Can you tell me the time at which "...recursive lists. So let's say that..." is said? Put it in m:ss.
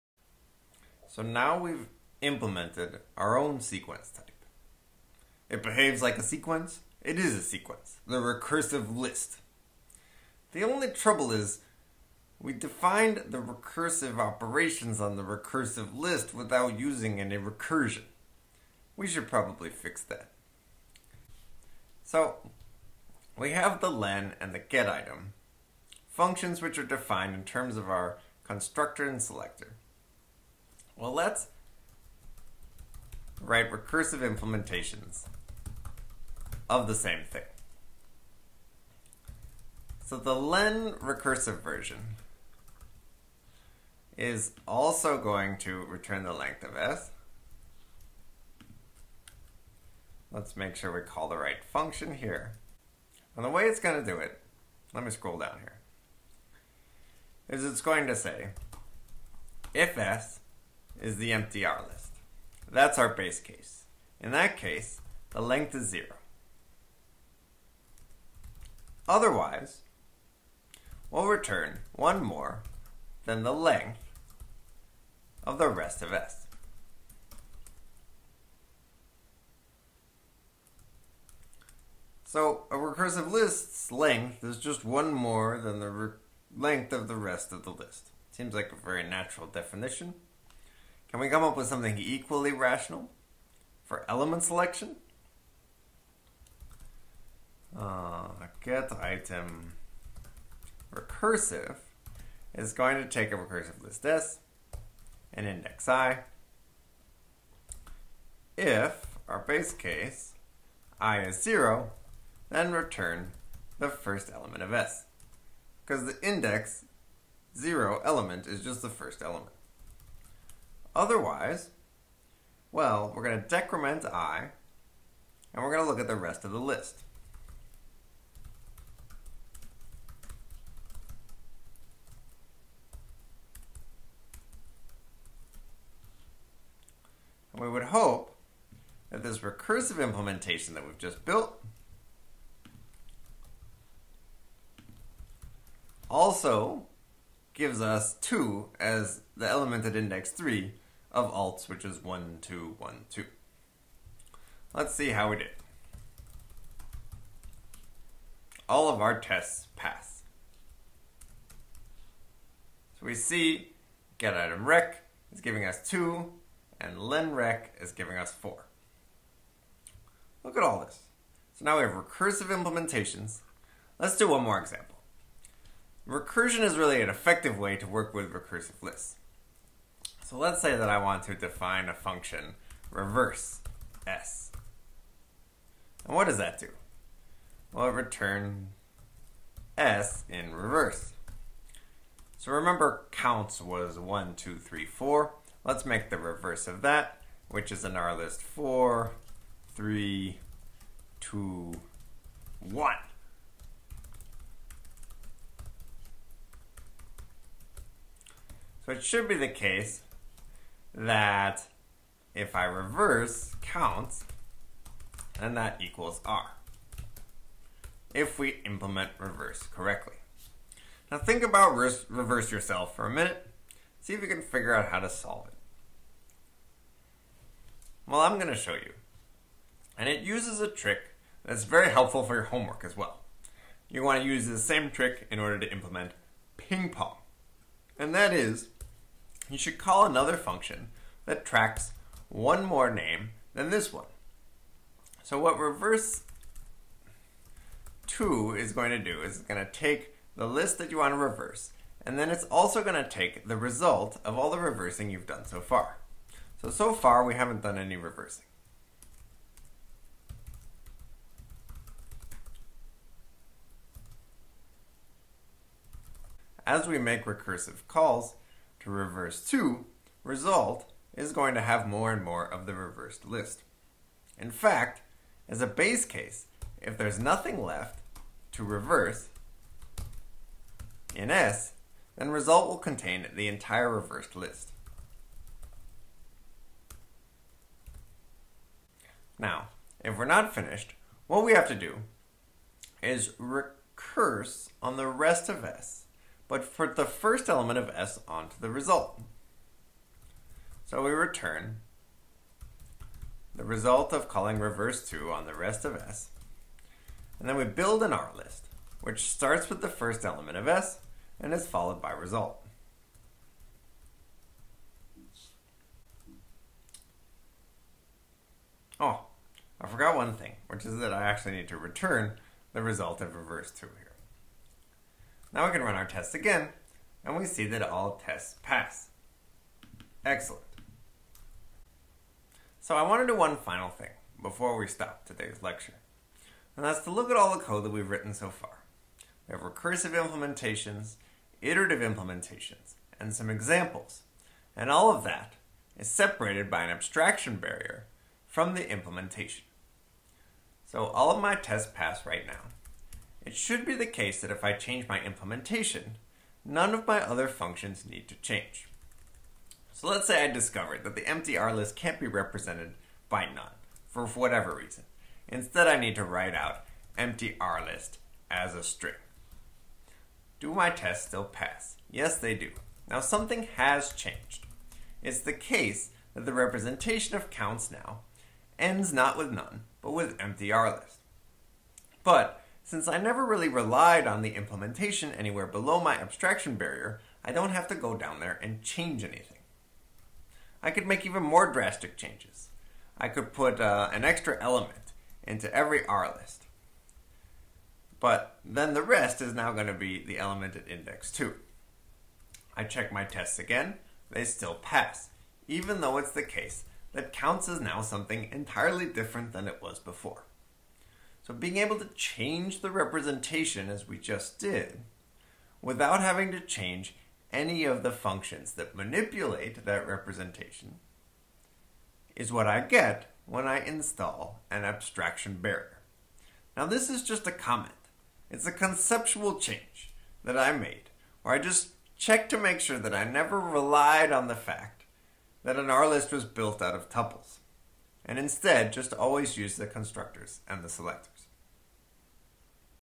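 2:58.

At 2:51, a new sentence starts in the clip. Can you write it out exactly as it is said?
So now we have recursive implementations.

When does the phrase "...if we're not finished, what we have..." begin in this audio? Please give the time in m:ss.
4:50.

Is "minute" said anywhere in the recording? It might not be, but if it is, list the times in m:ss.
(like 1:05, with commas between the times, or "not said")
3:43.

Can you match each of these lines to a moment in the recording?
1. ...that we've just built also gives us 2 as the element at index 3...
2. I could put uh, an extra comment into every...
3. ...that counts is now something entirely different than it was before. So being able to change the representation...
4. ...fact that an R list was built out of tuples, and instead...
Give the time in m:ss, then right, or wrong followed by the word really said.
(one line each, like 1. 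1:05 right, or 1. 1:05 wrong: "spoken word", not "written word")
1. 2:20 right
2. 6:33 wrong: "element", not "comment"
3. 6:47 right
4. 7:14 right.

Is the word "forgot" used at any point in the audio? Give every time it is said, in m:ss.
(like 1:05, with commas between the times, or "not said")
5:19.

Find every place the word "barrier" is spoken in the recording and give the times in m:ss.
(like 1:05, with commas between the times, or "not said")
5:47, 6:26, 7:05.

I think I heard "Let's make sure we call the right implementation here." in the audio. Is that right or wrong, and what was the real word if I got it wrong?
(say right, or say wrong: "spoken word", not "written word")
wrong: "function", not "implementation".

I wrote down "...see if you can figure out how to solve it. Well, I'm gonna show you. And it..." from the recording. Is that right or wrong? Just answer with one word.
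right.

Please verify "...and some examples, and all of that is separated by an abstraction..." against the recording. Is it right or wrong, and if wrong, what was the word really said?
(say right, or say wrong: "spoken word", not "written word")
right.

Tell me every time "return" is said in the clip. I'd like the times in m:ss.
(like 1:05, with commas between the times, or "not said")
0:45, 1:11, 1:52, 3:07, 5:01, 5:21.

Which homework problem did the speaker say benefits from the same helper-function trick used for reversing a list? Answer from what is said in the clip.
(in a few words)
ping pong.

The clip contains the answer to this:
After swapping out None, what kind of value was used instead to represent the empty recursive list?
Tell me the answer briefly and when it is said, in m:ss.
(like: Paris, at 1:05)
a string, at 6:08.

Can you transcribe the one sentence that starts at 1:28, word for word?
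Seems like a very natural definition.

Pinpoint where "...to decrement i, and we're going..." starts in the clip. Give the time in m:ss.
2:03.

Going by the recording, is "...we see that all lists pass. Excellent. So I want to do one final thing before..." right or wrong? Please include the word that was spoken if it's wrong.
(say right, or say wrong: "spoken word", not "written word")
wrong: "tests", not "lists".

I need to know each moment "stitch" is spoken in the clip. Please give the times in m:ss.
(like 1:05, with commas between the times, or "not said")
not said.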